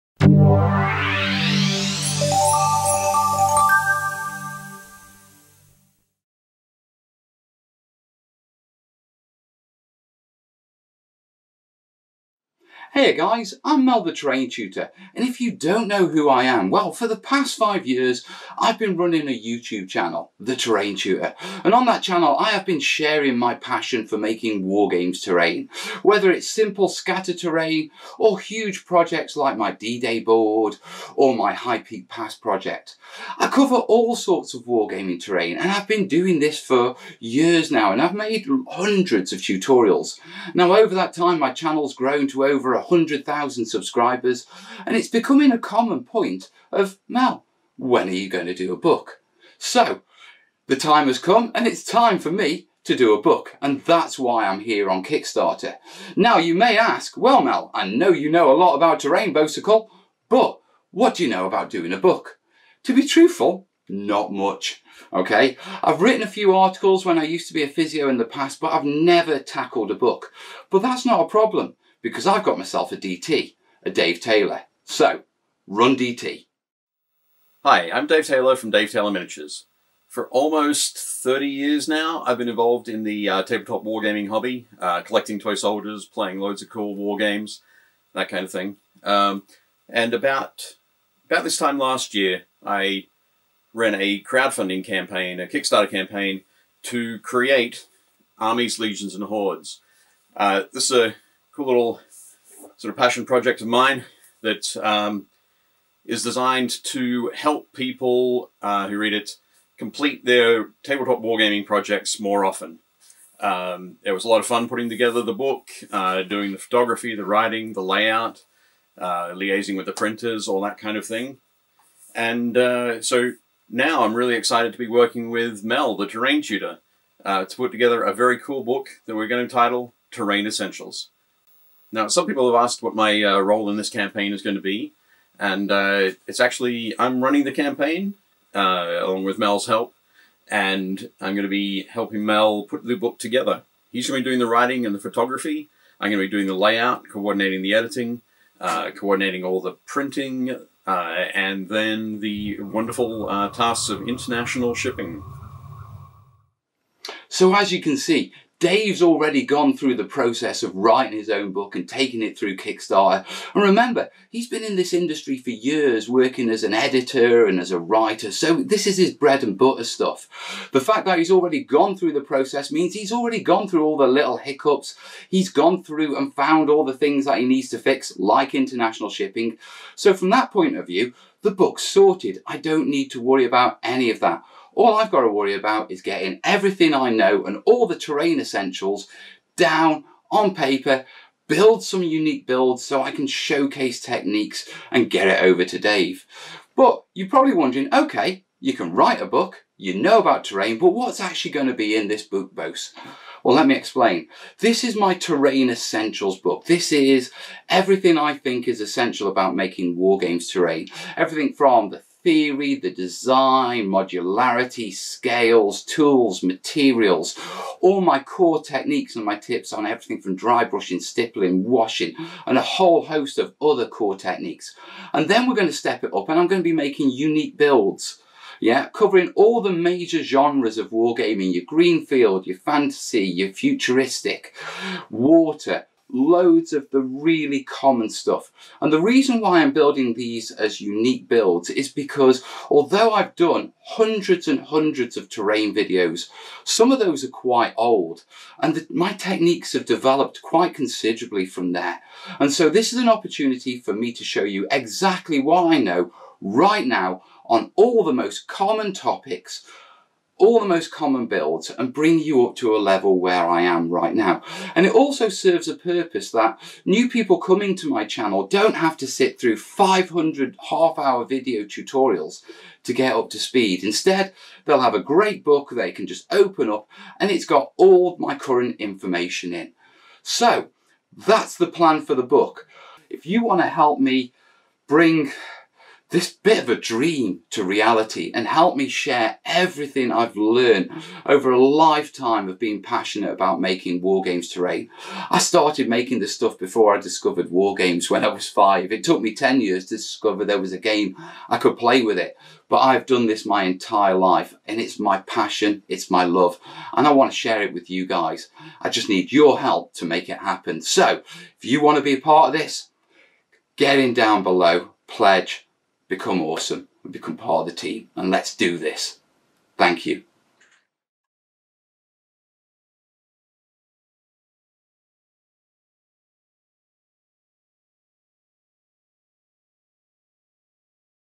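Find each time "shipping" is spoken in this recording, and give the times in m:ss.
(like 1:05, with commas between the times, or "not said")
2:34, 2:59.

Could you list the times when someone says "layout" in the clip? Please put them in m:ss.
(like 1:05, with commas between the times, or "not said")
1:57, 2:26.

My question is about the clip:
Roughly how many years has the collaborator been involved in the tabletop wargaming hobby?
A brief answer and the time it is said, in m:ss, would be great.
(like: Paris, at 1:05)
almost 30, at 1:20.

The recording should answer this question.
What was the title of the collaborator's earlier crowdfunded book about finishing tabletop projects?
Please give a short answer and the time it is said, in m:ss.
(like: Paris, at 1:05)
Armies, Legions, and Hordes, at 1:38.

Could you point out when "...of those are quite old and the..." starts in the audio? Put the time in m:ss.
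4:06.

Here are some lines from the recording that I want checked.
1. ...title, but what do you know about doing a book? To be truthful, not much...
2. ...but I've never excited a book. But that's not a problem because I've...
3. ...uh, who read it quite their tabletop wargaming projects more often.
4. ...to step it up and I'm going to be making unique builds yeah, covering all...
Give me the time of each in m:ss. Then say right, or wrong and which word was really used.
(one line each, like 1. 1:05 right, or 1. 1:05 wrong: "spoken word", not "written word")
1. 0:59 wrong: "bicycle", not "title"
2. 1:08 wrong: "tackled", not "excited"
3. 1:48 wrong: "complete", not "quite"
4. 3:45 right.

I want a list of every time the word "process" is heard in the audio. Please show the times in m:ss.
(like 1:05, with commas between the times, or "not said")
2:40, 2:52.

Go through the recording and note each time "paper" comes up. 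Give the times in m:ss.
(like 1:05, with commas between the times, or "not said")
3:10.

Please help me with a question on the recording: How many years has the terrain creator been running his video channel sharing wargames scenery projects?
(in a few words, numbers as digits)
5.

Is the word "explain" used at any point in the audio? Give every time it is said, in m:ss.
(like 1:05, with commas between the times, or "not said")
3:23.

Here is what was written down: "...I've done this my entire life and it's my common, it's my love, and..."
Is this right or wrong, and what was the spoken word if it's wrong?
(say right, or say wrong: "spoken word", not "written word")
wrong: "passion", not "common".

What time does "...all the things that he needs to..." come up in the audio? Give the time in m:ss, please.
2:56.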